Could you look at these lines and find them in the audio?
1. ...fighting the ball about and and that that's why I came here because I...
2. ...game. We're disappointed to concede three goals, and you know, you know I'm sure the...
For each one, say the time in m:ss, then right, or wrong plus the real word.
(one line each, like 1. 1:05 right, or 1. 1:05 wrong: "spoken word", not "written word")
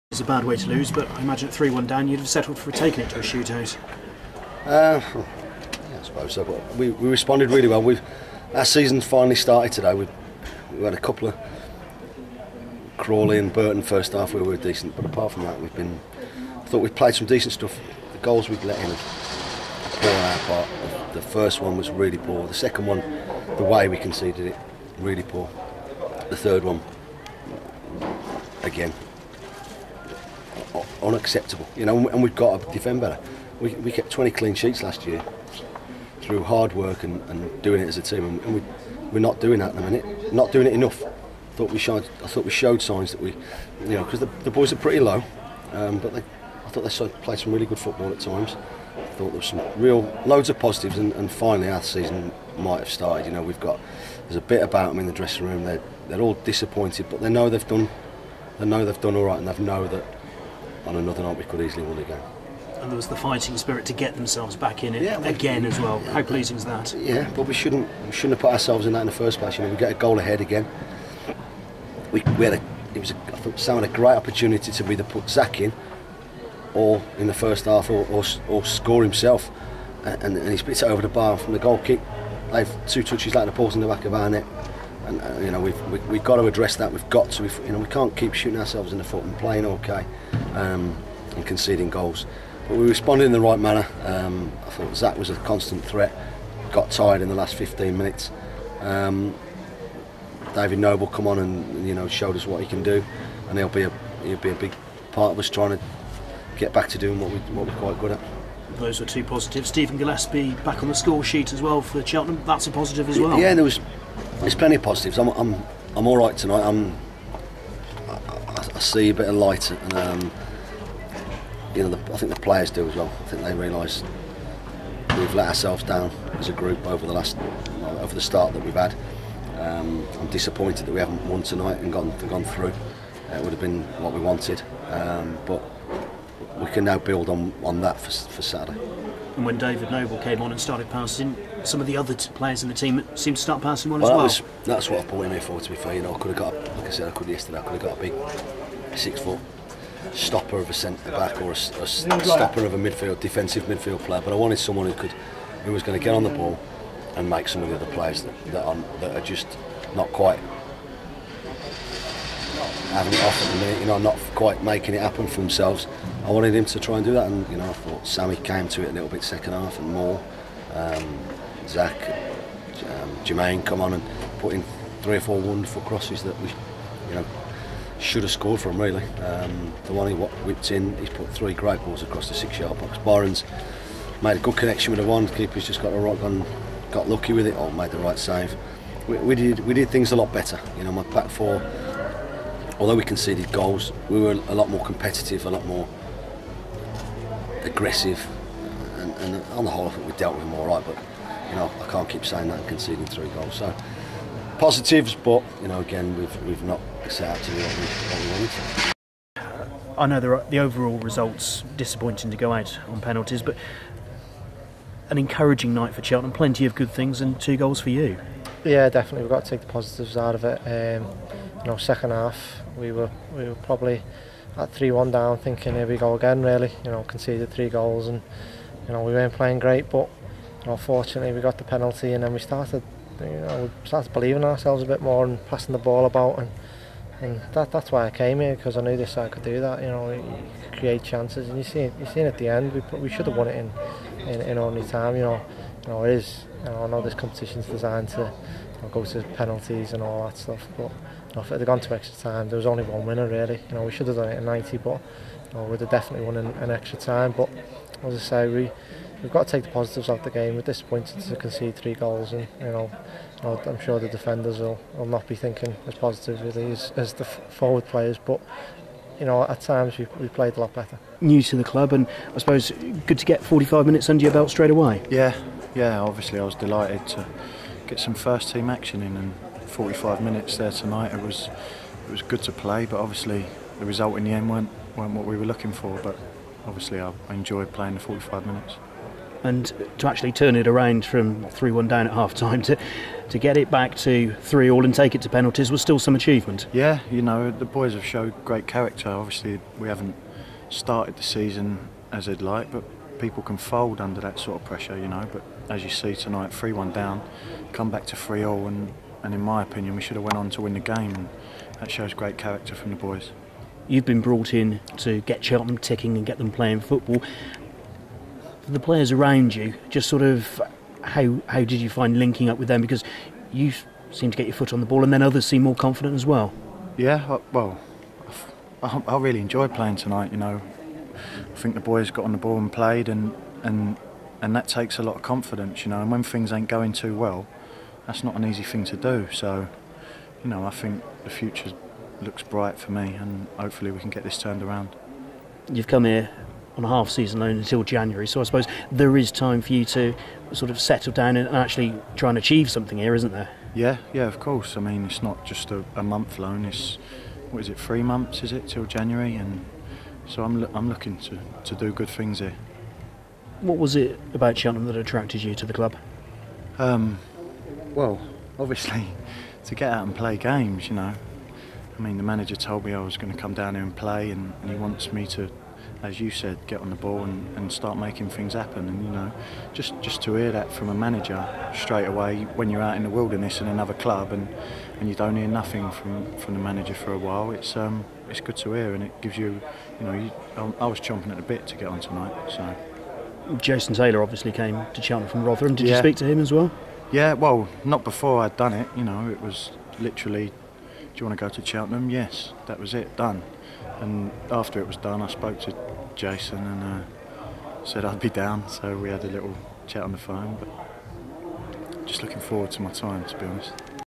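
1. 3:55 wrong: "passing", not "fighting"
2. 4:20 right.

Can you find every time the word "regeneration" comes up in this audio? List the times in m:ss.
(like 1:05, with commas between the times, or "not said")
not said.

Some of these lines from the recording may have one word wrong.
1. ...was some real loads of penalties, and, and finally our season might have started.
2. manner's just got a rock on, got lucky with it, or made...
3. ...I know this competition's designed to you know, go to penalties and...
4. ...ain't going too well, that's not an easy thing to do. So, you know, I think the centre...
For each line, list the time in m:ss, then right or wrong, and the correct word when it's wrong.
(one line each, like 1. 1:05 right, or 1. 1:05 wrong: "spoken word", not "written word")
1. 0:49 wrong: "positives", not "penalties"
2. 3:05 wrong: "keeper", not "manner"
3. 4:06 right
4. 5:36 wrong: "future", not "centre".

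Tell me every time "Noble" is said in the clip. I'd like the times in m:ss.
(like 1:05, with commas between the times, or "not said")
1:40, 2:19.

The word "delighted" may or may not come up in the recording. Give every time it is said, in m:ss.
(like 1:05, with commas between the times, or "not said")
4:36.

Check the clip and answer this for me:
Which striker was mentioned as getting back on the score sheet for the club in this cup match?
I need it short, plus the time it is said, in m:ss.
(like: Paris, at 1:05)
Steven Gillespie, at 1:49.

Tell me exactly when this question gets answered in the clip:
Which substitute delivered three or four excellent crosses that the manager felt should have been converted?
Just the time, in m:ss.
2:53.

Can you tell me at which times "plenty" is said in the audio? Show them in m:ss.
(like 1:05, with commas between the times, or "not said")
1:54, 3:36.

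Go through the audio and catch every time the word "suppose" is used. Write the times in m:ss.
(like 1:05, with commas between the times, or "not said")
0:06, 4:32, 5:48.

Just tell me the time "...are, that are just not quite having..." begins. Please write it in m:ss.
2:38.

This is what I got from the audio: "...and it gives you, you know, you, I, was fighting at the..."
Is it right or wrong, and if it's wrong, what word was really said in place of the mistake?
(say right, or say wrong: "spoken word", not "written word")
wrong: "chomping", not "fighting".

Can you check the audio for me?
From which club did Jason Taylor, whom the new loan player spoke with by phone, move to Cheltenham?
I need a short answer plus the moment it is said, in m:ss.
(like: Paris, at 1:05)
Rotherham, at 6:35.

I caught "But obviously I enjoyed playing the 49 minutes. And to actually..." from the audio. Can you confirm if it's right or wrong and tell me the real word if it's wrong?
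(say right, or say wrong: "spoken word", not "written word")
wrong: "45", not "49".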